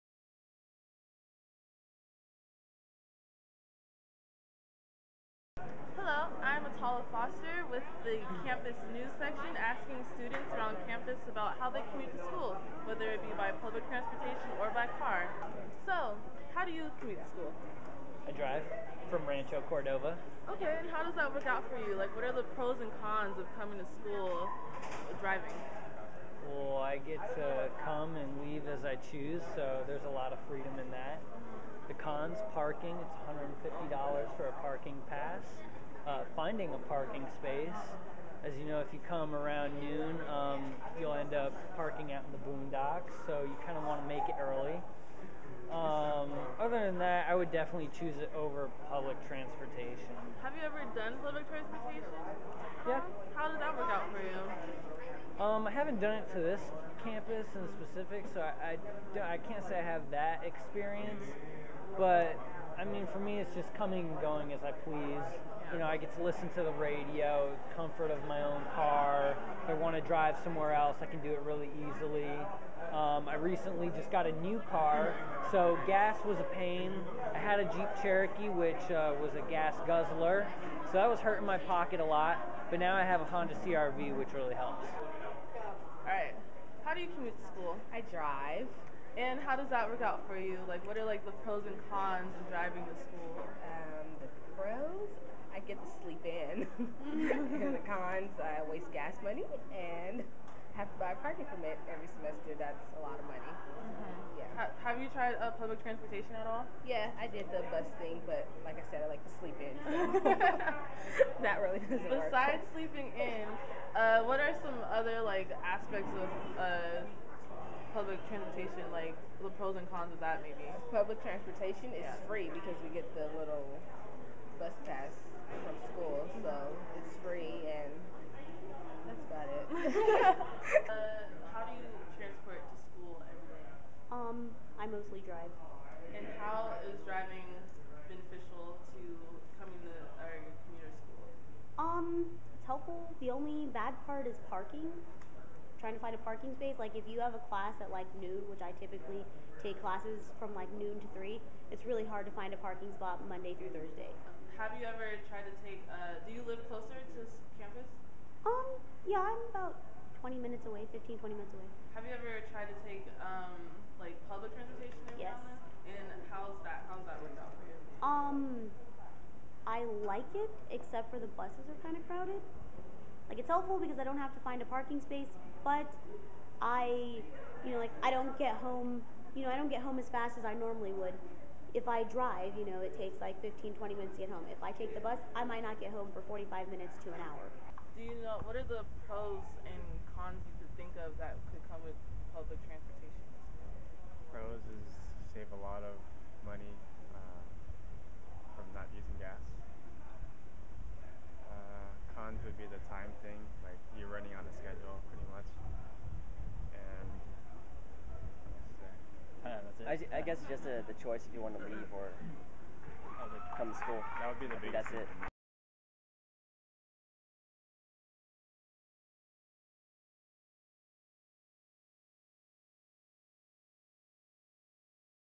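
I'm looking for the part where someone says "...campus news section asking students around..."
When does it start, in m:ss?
0:08.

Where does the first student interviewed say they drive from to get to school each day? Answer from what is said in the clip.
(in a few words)
Rancho Cordova.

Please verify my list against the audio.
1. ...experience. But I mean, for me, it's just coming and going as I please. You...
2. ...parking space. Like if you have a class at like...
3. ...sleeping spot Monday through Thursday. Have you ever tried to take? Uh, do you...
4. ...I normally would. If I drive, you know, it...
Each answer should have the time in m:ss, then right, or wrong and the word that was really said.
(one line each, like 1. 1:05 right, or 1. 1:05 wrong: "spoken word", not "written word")
1. 1:00 right
2. 2:26 right
3. 2:32 wrong: "parking", not "sleeping"
4. 3:00 right.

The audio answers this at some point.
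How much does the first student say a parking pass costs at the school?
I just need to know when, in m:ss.
0:33.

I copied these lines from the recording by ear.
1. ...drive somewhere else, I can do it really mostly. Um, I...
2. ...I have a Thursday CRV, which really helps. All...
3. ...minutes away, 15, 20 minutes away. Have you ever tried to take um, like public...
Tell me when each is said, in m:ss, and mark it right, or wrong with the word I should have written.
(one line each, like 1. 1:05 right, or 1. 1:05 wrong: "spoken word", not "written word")
1. 1:10 wrong: "easily", not "mostly"
2. 1:22 wrong: "Honda", not "Thursday"
3. 2:40 right.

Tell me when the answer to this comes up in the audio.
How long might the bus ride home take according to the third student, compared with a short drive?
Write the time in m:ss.
3:06.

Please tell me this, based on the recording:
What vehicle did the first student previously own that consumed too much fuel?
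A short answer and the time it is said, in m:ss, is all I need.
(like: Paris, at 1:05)
Jeep Cherokee, at 1:17.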